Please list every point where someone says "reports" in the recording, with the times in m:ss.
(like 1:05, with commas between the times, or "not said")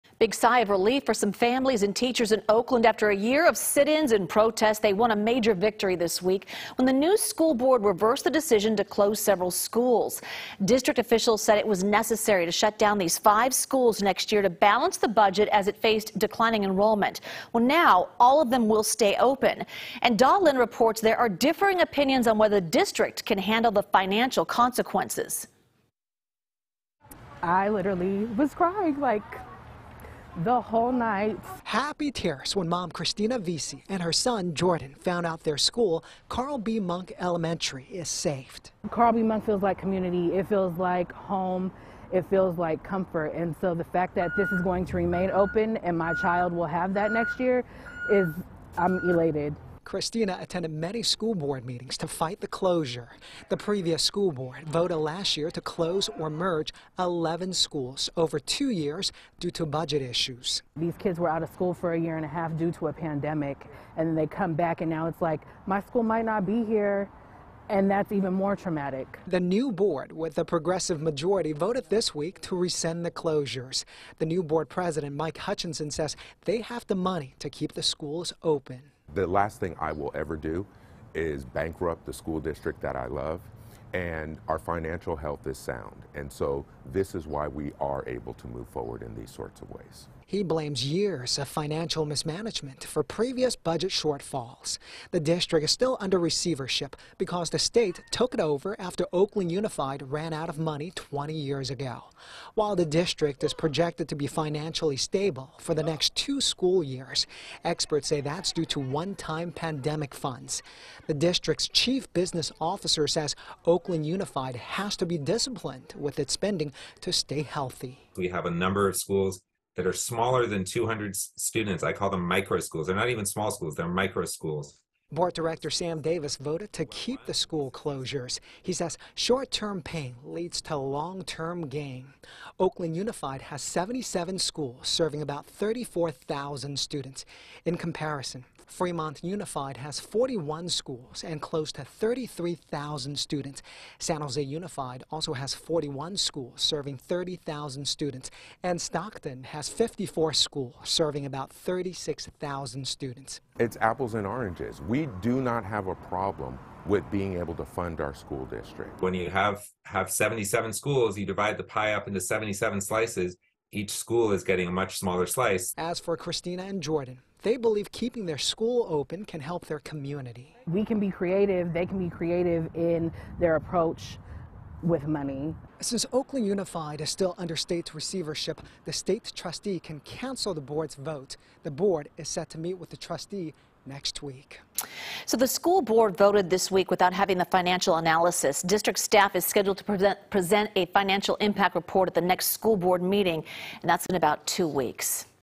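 0:20, 3:11.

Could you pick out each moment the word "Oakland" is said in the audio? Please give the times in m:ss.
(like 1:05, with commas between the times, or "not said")
0:02, 1:39, 1:53, 2:12, 2:56.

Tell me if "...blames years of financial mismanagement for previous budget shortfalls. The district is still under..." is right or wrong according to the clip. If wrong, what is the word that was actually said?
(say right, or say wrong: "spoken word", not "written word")
right.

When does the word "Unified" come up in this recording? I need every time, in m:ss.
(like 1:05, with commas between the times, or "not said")
1:39, 1:54, 2:12, 2:19, 2:24, 2:56.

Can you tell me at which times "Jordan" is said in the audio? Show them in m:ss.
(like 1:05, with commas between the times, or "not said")
0:34, 2:46.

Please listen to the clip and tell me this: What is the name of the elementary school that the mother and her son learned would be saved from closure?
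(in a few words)
Carl B. Munck Elementary.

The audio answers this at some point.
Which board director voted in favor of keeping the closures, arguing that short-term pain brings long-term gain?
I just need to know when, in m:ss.
2:05.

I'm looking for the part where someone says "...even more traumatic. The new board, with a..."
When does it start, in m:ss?
1:08.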